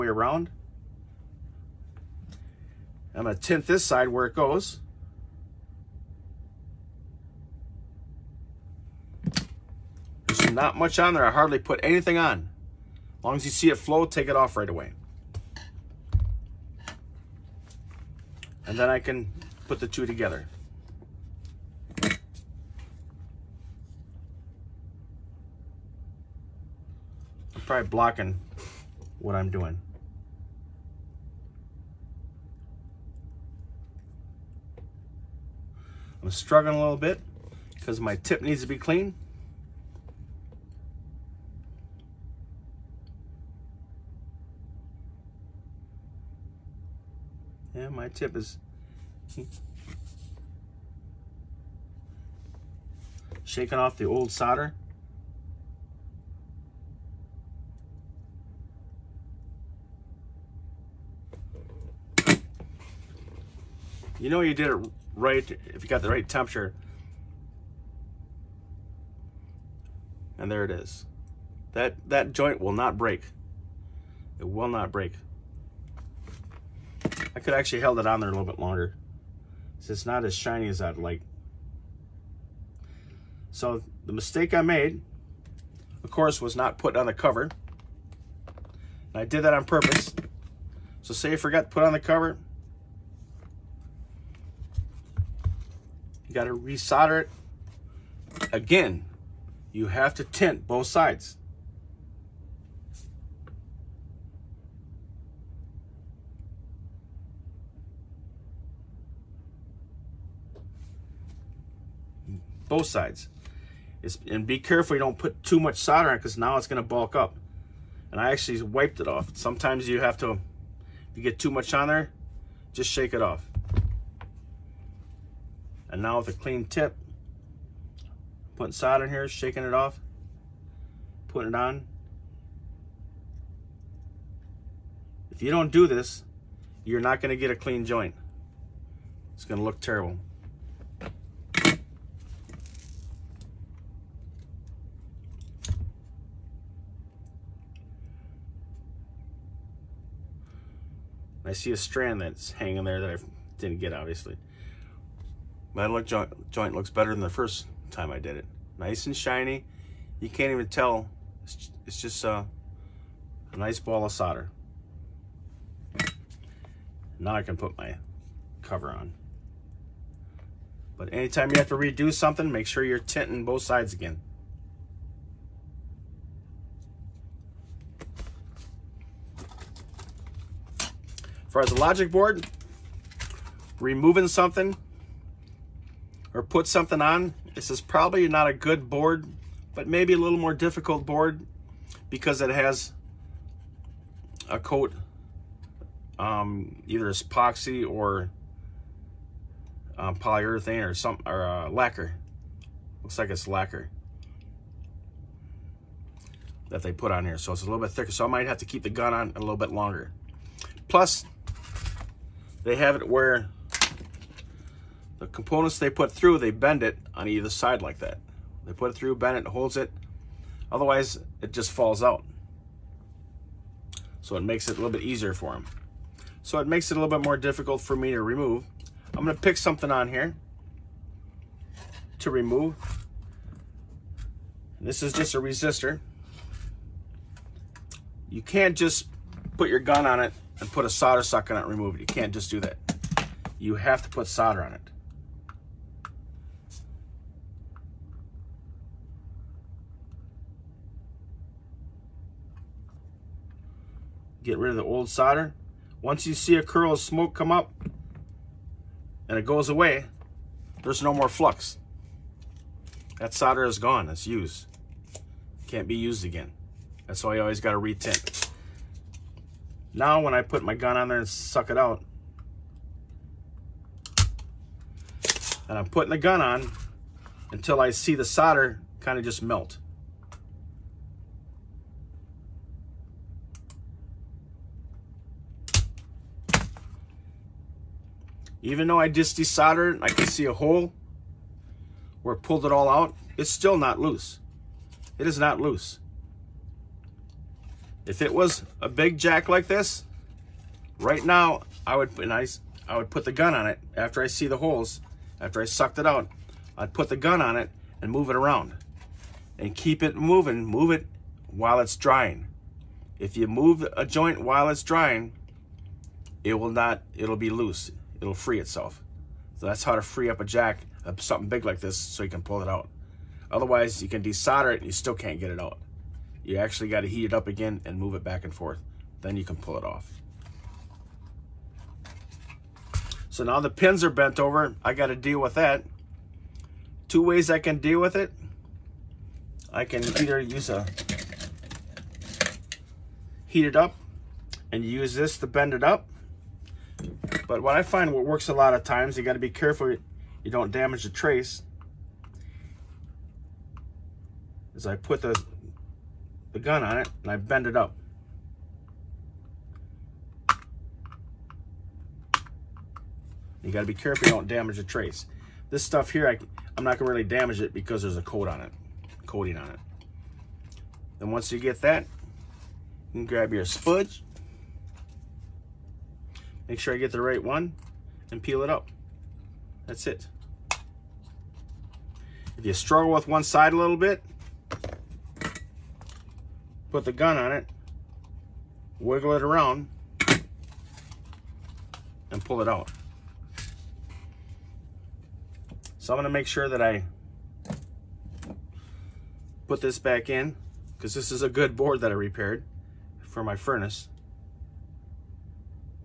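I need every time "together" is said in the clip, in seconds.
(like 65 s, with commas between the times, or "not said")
20 s.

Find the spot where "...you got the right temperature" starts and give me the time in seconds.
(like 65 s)
65 s.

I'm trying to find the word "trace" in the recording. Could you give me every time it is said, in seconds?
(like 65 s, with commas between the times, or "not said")
351 s, 364 s.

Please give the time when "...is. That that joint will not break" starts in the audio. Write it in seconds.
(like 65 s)
70 s.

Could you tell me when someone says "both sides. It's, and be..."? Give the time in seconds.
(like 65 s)
112 s.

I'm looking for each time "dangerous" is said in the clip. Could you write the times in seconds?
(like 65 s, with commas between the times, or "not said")
not said.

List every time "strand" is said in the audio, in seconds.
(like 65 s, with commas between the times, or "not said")
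151 s.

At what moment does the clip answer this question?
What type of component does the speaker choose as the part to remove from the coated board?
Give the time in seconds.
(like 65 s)
235 s.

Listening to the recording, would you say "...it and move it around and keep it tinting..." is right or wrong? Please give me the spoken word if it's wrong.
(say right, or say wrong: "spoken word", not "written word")
wrong: "moving", not "tinting".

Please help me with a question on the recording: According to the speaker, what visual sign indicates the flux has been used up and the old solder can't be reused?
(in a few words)
A curl of smoke.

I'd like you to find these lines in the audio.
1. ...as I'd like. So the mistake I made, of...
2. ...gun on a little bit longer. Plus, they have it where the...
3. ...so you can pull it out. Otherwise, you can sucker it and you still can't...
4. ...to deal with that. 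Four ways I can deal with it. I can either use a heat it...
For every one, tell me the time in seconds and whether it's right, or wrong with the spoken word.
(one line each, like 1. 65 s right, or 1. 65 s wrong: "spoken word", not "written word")
1. 80 s right
2. 208 s right
3. 321 s wrong: "desolder", not "sucker"
4. 335 s wrong: "Two", not "Four".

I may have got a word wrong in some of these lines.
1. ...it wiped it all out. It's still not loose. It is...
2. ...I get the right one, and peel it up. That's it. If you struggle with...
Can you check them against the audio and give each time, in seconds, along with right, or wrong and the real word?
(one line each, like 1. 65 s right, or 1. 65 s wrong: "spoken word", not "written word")
1. 292 s wrong: "pulled", not "wiped"
2. 376 s right.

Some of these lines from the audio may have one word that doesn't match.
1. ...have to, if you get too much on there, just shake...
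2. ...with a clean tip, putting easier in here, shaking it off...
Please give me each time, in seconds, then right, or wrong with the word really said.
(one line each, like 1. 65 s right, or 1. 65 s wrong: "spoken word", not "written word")
1. 120 s right
2. 126 s wrong: "solder", not "easier".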